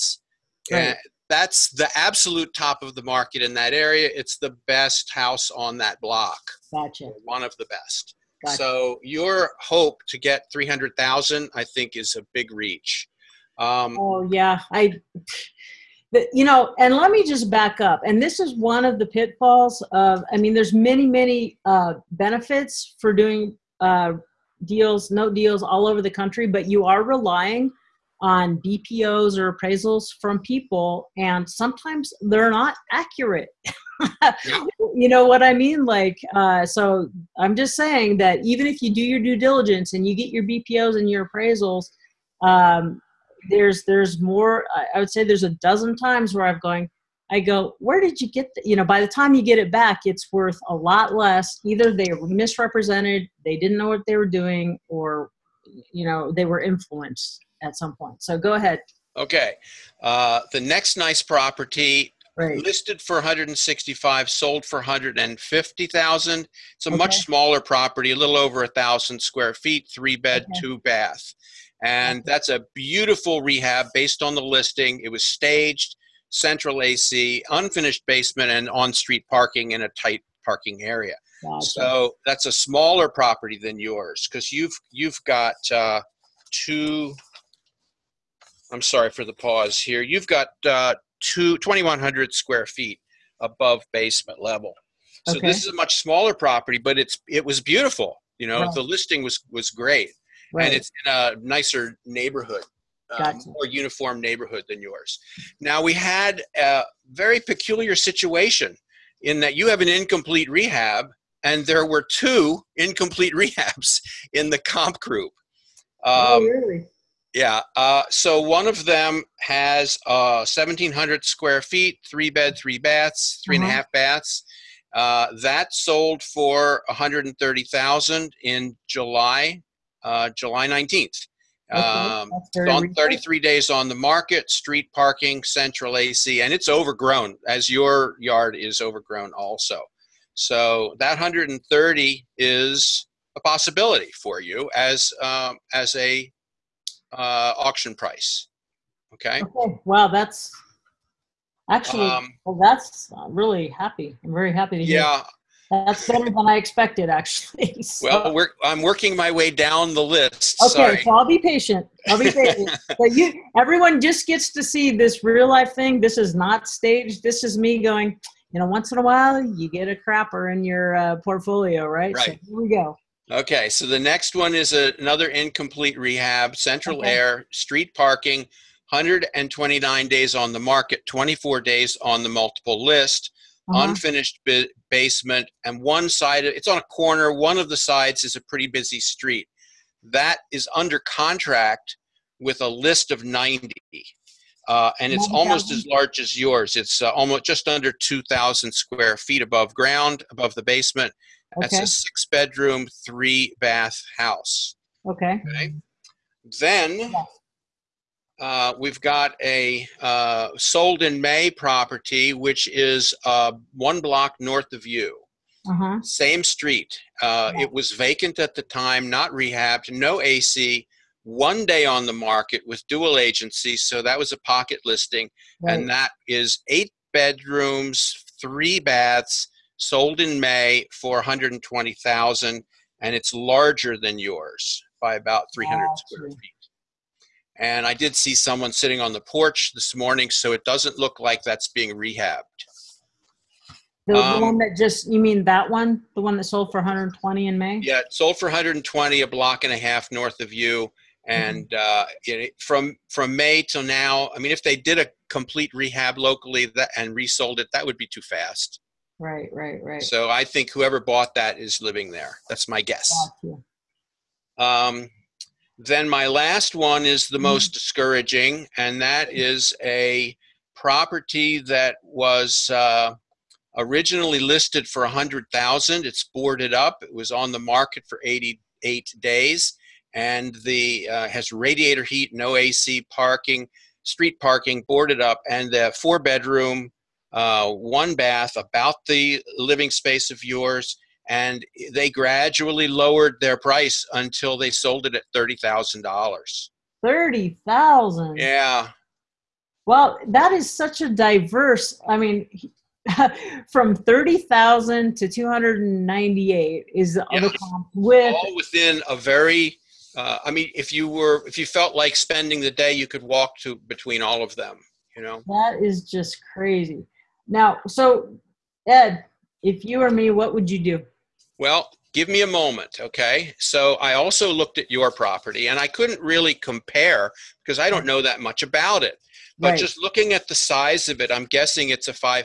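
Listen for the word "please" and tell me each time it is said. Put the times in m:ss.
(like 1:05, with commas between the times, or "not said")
not said.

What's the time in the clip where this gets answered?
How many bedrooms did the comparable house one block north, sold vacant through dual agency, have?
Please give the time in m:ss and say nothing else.
3:46.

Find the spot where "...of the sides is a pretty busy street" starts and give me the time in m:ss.
3:07.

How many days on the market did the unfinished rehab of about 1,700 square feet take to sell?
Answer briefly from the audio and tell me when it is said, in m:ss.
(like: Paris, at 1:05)
33 days, at 2:12.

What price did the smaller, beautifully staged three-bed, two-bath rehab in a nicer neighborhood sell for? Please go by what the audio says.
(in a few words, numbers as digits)
$150,000.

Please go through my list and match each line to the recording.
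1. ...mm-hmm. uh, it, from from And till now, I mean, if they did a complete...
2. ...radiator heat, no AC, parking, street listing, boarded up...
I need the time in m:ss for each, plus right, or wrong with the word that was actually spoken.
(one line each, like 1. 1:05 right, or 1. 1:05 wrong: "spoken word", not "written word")
1. 4:11 wrong: "May", not "And"
2. 4:41 wrong: "parking", not "listing".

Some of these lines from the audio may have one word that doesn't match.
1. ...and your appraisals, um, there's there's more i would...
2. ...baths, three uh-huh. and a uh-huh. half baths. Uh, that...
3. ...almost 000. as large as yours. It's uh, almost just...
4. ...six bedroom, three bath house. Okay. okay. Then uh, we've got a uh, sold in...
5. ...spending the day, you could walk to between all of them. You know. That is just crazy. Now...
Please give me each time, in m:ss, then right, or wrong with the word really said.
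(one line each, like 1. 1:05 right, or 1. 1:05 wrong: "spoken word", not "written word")
1. 0:40 right
2. 2:02 right
3. 3:15 right
4. 3:21 right
5. 5:12 right.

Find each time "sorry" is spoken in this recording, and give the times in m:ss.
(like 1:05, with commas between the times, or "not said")
1:28, 2:40.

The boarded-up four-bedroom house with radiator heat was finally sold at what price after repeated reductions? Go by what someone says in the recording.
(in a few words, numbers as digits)
$30,000.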